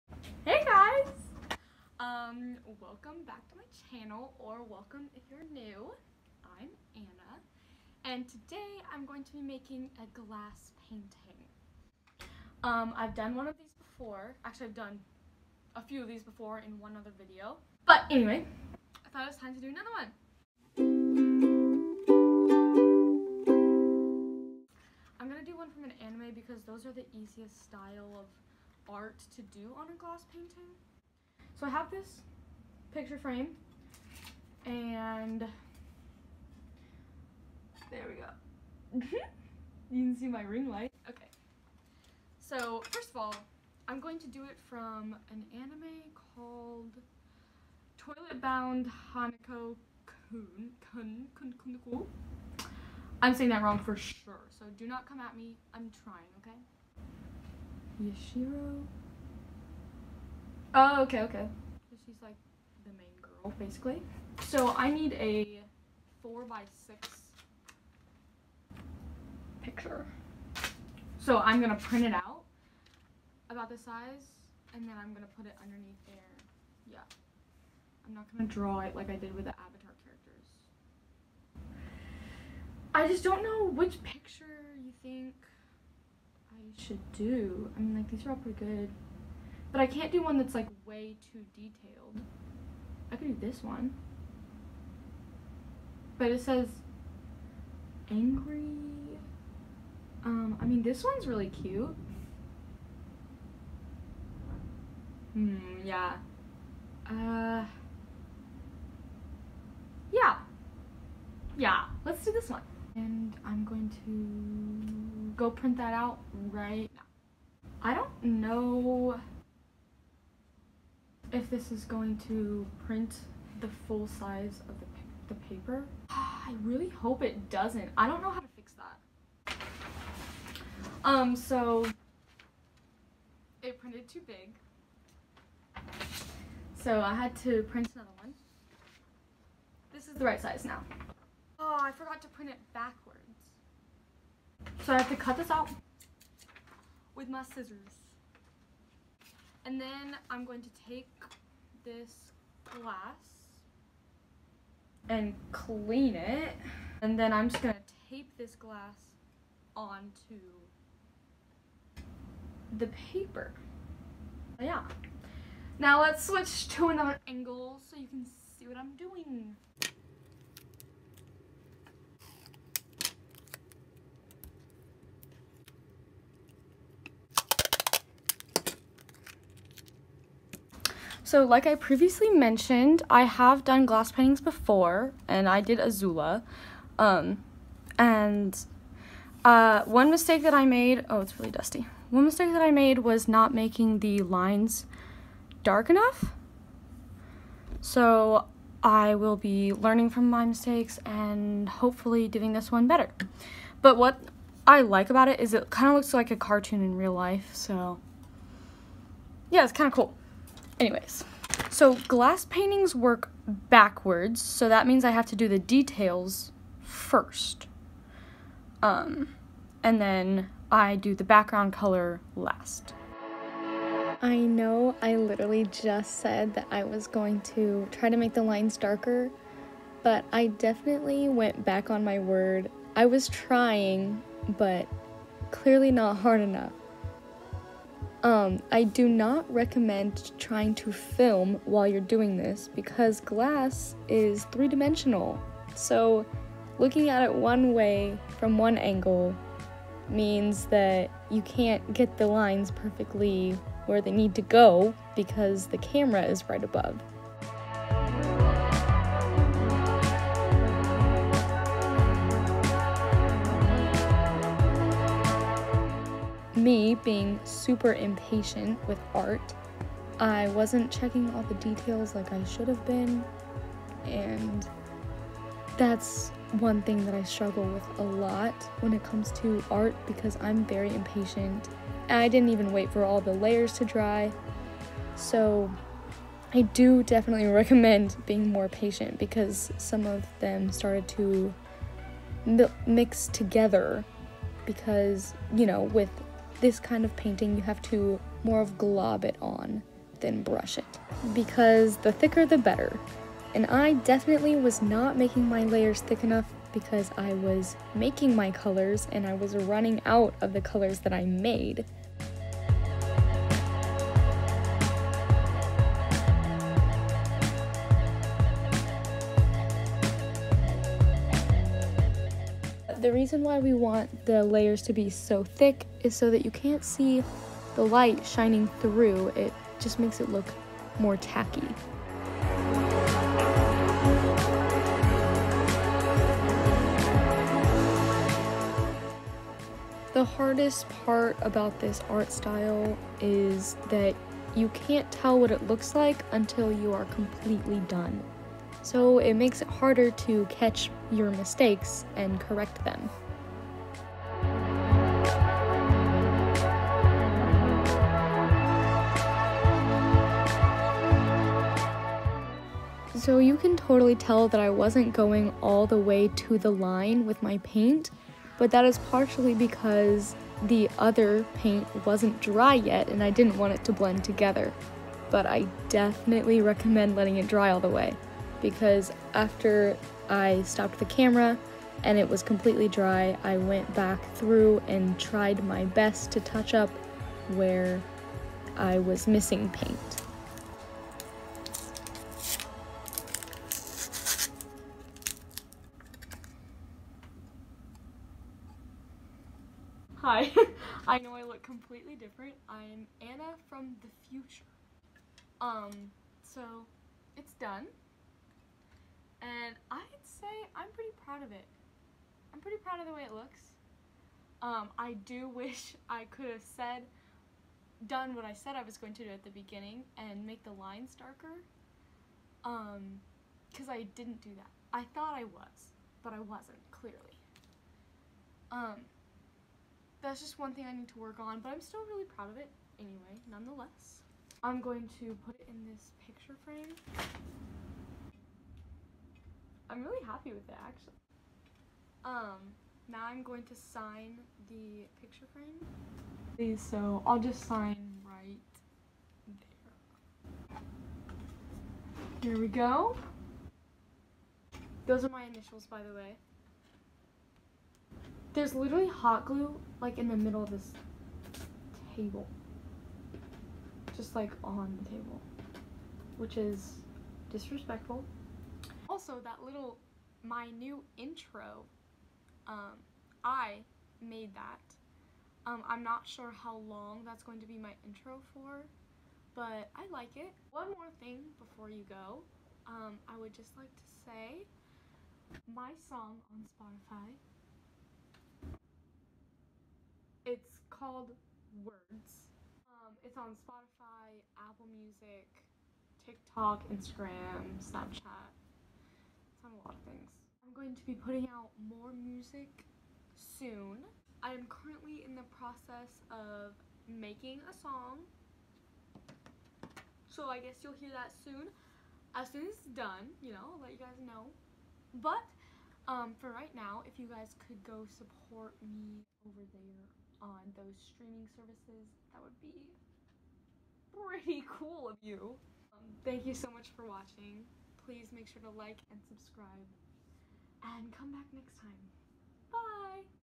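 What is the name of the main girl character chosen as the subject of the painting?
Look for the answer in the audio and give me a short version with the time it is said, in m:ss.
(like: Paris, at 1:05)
Yashiro, at 0:58.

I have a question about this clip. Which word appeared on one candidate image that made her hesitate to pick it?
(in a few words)
angry.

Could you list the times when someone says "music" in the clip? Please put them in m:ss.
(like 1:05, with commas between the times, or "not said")
8:14, 8:22.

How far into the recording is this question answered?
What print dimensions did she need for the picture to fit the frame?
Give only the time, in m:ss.
1:06.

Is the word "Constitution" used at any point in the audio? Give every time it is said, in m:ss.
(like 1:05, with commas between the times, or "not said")
not said.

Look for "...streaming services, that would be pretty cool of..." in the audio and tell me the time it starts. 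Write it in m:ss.
8:40.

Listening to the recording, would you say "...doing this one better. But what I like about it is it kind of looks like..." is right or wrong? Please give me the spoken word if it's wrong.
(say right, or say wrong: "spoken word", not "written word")
right.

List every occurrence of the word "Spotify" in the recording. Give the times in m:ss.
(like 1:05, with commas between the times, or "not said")
8:06, 8:13.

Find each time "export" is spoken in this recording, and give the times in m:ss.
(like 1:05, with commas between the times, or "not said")
not said.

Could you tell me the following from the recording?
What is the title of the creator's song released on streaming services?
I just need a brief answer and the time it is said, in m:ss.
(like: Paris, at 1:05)
Words, at 8:11.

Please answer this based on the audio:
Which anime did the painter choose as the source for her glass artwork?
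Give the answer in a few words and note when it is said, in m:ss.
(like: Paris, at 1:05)
Toilet Bound Hanako Kun, at 0:47.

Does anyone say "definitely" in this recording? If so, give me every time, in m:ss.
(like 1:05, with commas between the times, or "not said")
3:50, 4:47, 5:03, 6:15.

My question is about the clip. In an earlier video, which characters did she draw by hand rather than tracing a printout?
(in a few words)
Avatar characters.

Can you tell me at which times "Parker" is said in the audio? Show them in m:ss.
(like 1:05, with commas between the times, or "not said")
not said.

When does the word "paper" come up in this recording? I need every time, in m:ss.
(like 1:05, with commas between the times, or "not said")
2:05, 2:43.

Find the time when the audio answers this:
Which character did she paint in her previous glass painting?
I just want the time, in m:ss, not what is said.
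3:05.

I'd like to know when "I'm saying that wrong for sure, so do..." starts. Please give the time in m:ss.
0:53.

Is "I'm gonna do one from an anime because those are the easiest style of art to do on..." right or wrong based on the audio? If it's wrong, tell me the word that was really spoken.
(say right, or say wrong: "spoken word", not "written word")
right.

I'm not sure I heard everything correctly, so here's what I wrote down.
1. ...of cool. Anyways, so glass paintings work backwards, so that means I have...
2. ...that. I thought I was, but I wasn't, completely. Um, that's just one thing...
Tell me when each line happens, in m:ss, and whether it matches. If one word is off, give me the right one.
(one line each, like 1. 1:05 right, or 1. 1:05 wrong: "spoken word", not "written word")
1. 3:29 right
2. 7:04 wrong: "clearly", not "completely".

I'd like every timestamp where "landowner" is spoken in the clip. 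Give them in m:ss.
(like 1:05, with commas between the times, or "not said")
not said.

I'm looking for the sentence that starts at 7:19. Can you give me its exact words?
I'm really happy with it actually.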